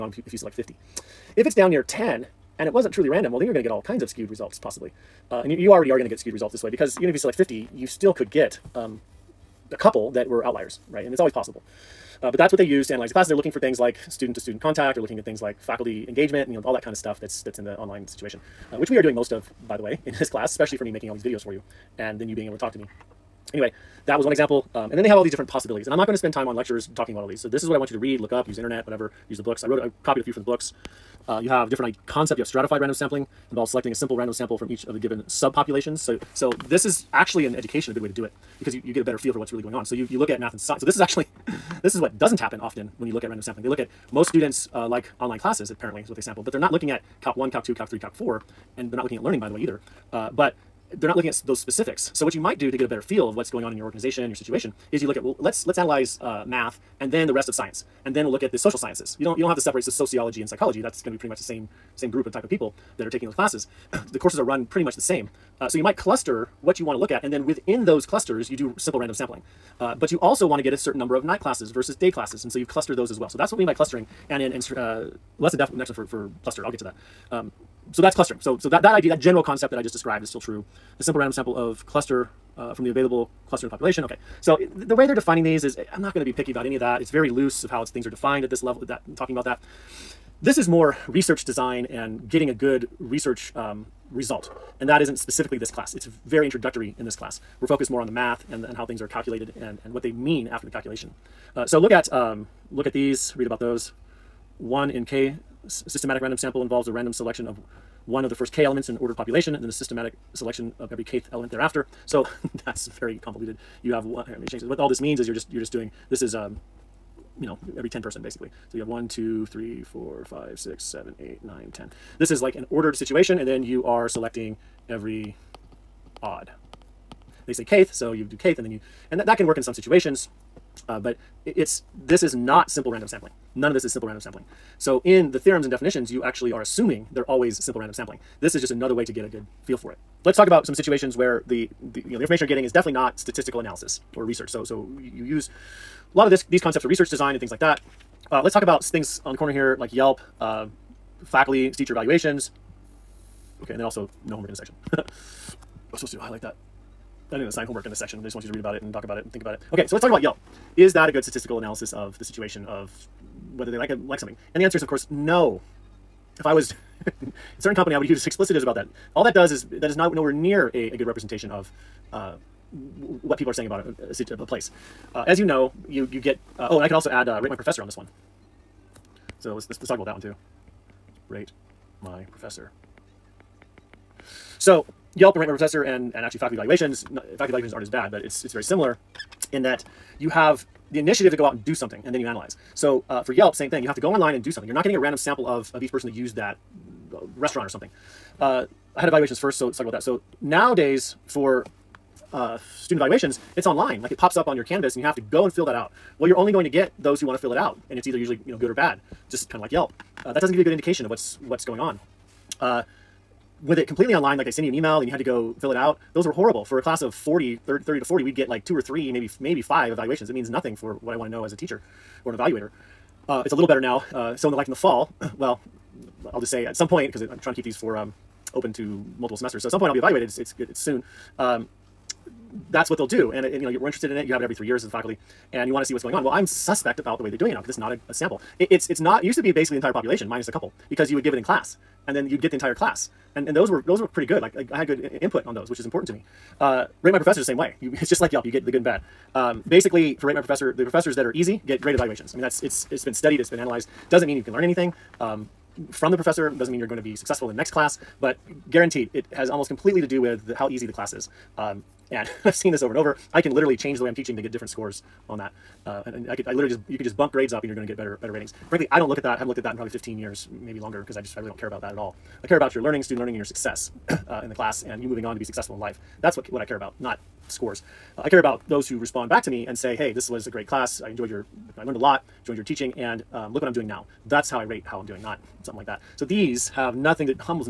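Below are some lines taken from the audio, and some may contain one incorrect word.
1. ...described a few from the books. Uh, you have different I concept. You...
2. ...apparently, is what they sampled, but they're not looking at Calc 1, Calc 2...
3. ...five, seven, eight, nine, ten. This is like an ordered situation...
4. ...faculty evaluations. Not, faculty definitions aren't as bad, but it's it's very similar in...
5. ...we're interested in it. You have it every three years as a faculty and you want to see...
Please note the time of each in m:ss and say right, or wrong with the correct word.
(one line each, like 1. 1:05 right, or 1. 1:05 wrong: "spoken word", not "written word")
1. 0:30 wrong: "copied", not "described"
2. 0:45 right
3. 2:00 wrong: "six", not "five"
4. 3:06 wrong: "evaluations", not "definitions"
5. 3:53 right.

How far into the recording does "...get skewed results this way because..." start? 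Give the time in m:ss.
0:06.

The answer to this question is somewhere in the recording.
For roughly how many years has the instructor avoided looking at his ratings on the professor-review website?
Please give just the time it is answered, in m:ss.
4:29.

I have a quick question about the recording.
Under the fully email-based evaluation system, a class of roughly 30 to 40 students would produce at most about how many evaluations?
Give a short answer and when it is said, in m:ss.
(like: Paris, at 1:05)
5, at 3:39.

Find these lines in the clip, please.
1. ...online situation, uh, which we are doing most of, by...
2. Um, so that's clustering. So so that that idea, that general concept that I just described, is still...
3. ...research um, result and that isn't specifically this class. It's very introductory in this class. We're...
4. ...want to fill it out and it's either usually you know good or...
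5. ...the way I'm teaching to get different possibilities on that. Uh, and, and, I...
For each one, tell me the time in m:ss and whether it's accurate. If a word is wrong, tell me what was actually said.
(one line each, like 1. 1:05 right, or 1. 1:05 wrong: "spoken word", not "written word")
1. 0:17 right
2. 1:17 right
3. 1:32 right
4. 3:27 right
5. 4:23 wrong: "scores", not "possibilities".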